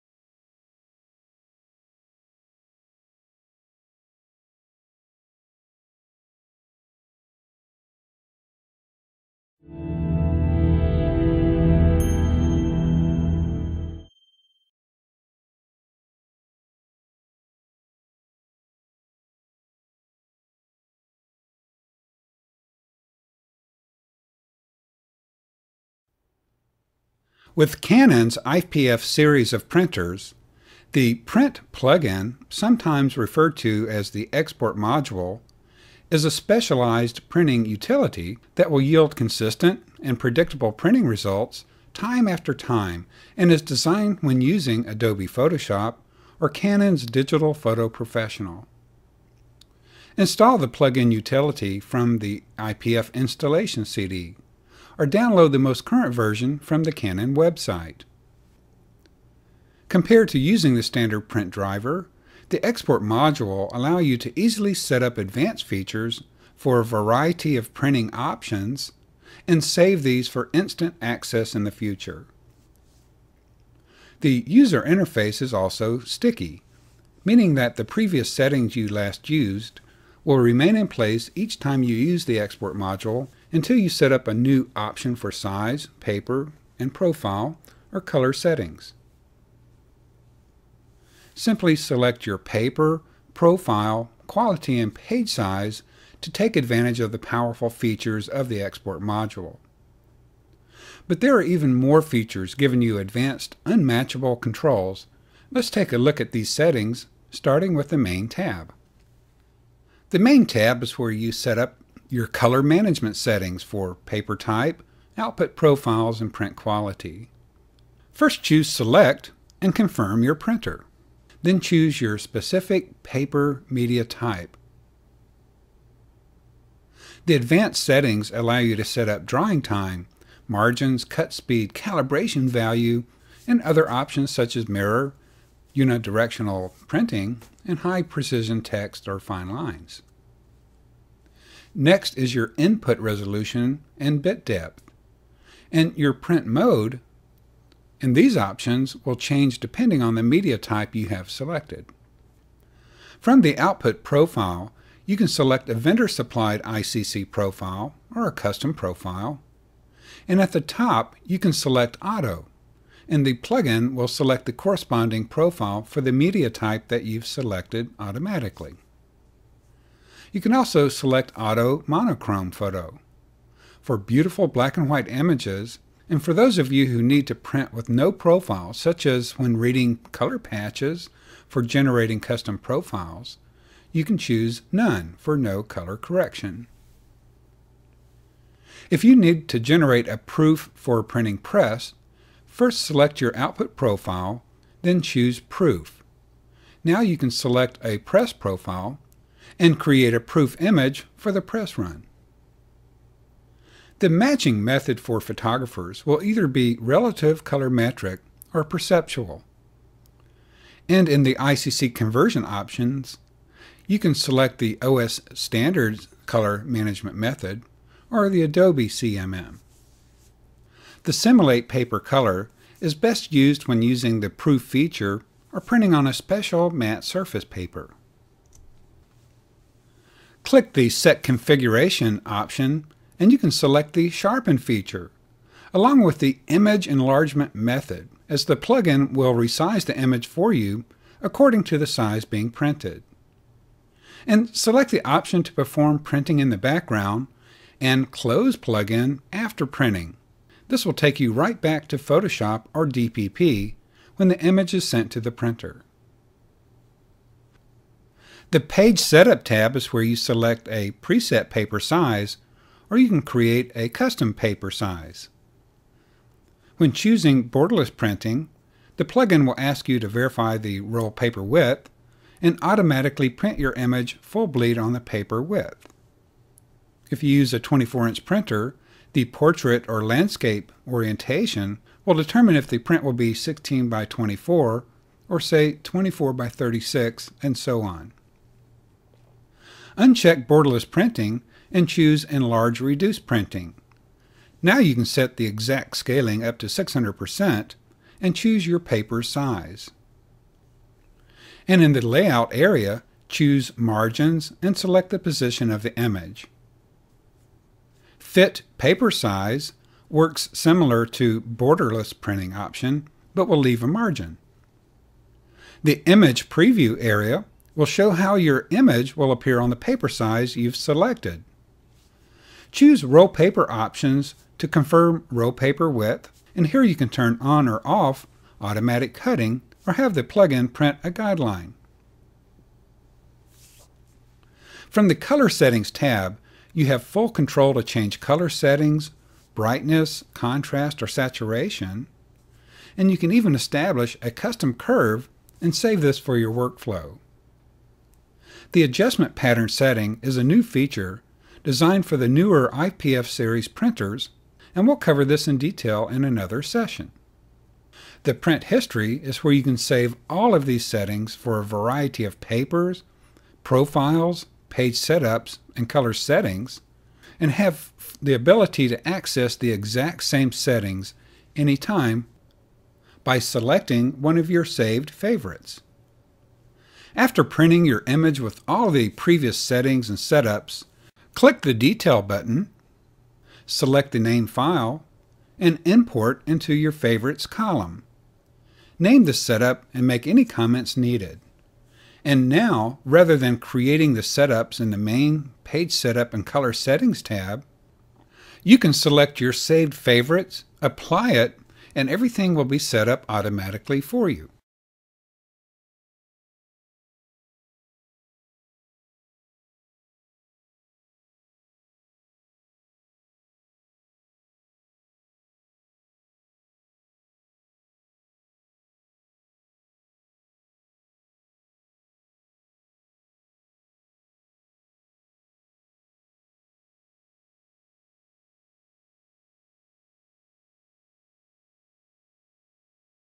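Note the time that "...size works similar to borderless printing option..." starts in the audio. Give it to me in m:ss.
5:09.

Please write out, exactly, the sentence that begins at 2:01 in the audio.
Then choose your specific paper media type.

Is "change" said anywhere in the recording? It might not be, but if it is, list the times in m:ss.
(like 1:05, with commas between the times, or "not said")
2:29, 5:37.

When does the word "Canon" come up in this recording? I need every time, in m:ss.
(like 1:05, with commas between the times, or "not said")
0:27, 0:46, 0:56.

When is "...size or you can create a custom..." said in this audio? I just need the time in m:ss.
4:21.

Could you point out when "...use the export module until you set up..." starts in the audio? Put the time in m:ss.
1:21.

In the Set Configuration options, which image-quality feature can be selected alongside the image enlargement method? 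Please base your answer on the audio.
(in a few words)
Sharpen.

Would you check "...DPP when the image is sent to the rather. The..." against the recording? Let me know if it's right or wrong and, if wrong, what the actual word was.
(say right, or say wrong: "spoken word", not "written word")
wrong: "printer", not "rather".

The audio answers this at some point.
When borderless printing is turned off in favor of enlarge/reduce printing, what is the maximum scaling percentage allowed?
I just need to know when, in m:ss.
4:56.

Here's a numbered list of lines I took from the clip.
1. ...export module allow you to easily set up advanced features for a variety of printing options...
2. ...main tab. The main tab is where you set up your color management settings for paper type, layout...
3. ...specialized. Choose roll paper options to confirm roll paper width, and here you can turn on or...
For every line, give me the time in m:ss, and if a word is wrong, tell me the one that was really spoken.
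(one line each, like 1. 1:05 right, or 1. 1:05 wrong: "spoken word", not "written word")
1. 1:02 right
2. 1:47 wrong: "output", not "layout"
3. 5:20 wrong: "selected", not "specialized".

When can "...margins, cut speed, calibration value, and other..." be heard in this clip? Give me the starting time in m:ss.
2:10.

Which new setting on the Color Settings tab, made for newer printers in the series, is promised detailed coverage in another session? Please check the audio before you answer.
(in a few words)
Adjustment Pattern.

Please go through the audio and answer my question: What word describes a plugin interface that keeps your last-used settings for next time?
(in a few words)
Sticky.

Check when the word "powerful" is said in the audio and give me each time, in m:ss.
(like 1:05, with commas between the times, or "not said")
1:37.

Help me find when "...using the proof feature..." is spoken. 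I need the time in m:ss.
3:43.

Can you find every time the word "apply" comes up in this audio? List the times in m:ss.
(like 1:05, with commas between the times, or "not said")
6:40.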